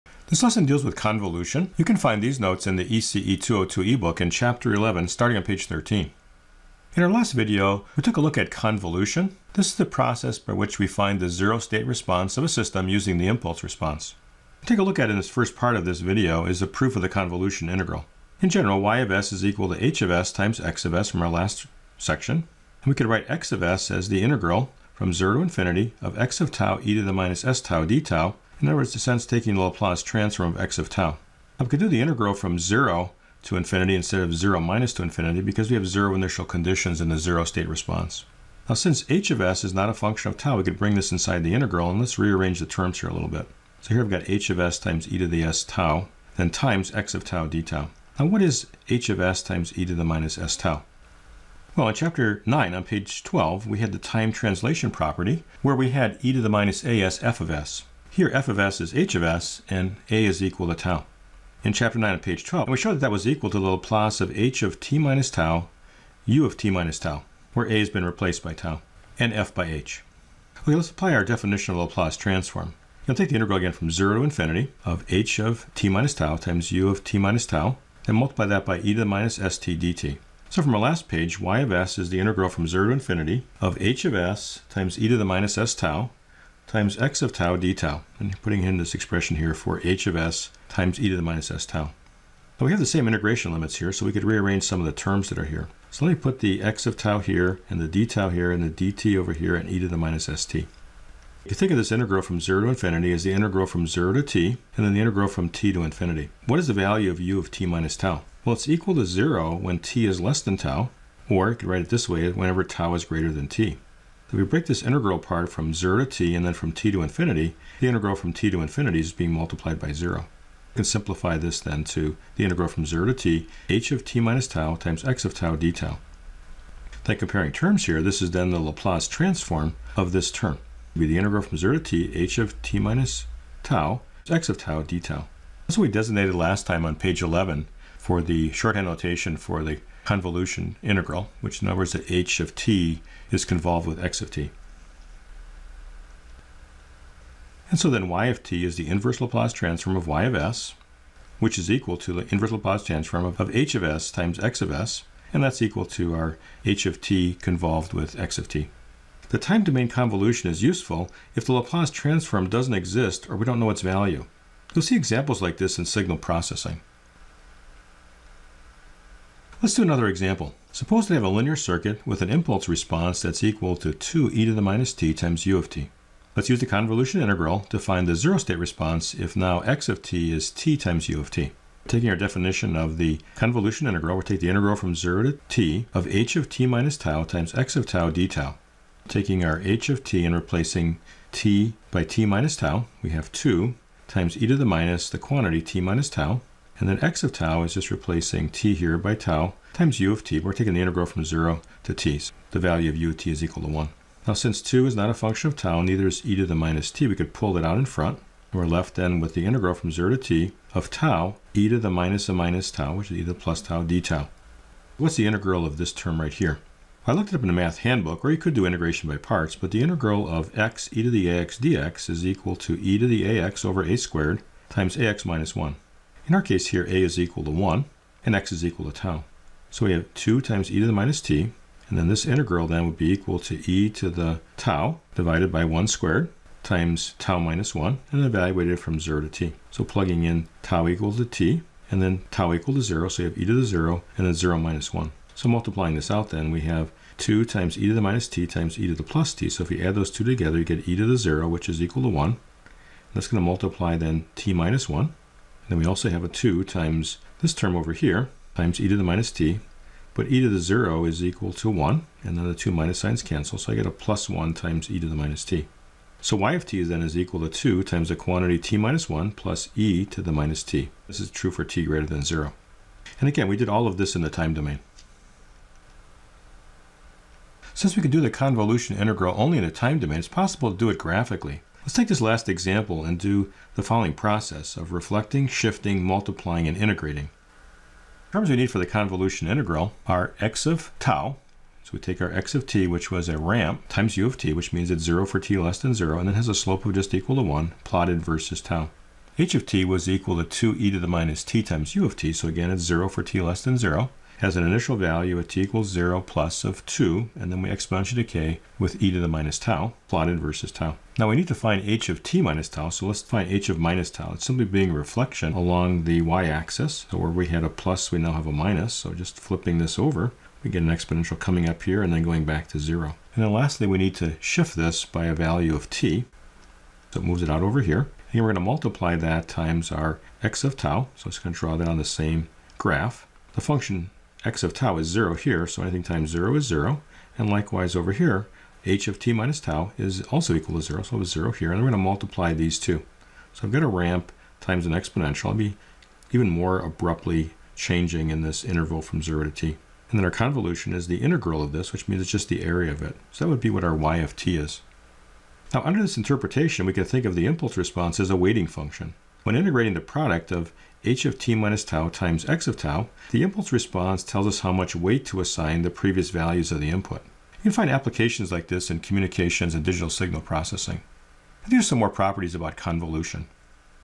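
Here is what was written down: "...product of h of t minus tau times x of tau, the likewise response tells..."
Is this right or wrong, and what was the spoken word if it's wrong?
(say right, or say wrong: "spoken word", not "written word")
wrong: "impulse", not "likewise".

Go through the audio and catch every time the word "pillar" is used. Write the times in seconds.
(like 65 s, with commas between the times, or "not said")
not said.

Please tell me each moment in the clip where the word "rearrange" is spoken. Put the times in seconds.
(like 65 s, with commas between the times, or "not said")
42 s, 94 s.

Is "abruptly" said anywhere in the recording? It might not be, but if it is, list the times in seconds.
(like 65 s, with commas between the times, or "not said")
346 s.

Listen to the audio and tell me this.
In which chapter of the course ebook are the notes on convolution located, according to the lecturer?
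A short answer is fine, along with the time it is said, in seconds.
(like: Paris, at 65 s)
11, at 4 s.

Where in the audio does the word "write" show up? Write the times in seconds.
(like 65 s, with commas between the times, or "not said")
23 s, 111 s.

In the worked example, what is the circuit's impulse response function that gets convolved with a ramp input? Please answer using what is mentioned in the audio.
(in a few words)
2e^(-t)u(t).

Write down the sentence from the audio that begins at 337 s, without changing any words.
And likewise over here, h of t minus tau is also equal to 0, so it's 0 here.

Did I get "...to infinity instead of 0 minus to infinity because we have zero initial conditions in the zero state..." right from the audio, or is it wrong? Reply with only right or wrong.
right.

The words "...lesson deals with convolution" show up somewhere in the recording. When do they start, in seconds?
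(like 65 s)
0 s.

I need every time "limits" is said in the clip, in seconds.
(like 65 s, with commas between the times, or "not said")
93 s.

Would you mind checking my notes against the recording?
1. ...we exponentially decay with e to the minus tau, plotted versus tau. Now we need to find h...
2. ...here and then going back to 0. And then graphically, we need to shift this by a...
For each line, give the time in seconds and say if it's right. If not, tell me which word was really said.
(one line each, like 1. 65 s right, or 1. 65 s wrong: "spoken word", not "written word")
1. 307 s right
2. 321 s wrong: "lastly", not "graphically".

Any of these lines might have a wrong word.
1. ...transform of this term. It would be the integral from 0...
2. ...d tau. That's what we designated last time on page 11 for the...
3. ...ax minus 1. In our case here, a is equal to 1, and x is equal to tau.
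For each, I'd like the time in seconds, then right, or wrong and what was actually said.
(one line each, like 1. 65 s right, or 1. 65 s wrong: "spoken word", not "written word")
1. 129 s right
2. 134 s right
3. 224 s right.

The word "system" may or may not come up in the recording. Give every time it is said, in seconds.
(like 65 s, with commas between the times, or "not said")
12 s.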